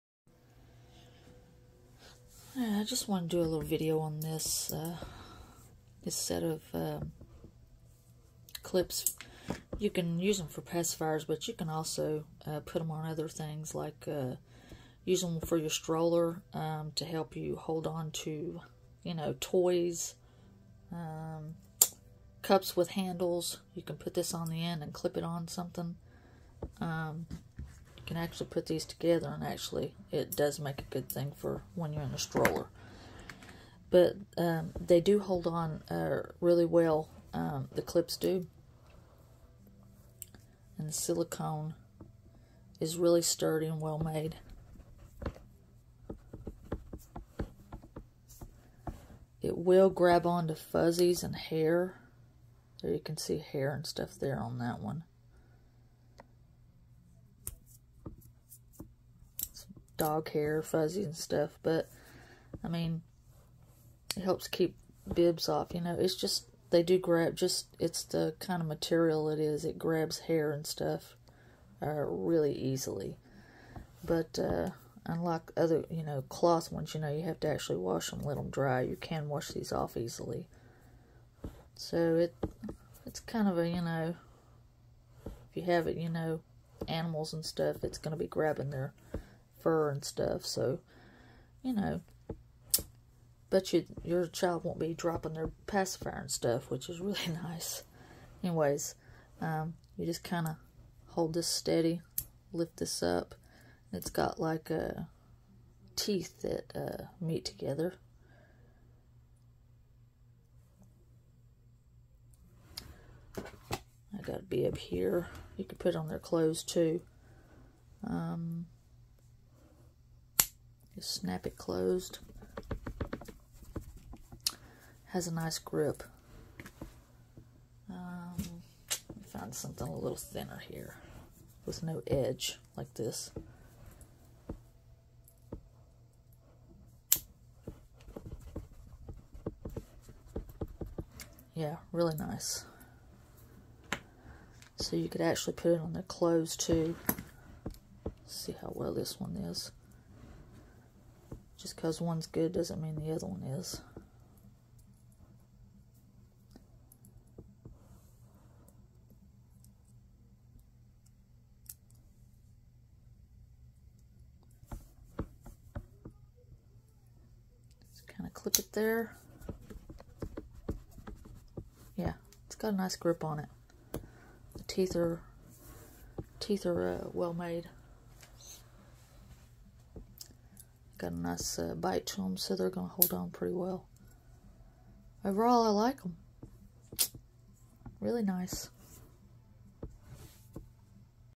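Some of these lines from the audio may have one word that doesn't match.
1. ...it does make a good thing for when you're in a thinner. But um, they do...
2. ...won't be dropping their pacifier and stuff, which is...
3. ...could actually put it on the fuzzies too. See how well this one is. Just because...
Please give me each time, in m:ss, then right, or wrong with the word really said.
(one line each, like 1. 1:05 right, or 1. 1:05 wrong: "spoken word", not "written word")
1. 0:30 wrong: "stroller", not "thinner"
2. 1:34 right
3. 2:25 wrong: "clothes", not "fuzzies".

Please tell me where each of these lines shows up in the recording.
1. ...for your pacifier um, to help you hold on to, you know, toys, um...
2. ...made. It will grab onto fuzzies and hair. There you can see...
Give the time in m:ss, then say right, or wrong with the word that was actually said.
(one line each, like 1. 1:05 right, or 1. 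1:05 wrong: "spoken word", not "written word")
1. 0:15 wrong: "stroller", not "pacifier"
2. 0:43 right.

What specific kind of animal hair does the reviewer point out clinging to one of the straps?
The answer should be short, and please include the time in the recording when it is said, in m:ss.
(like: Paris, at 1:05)
Dog hair, at 1:00.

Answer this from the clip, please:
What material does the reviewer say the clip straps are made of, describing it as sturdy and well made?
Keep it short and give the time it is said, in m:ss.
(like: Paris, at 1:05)
Silicone, at 0:40.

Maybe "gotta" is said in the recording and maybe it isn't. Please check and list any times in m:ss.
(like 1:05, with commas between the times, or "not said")
1:54.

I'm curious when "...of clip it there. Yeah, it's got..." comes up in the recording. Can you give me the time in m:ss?
2:48.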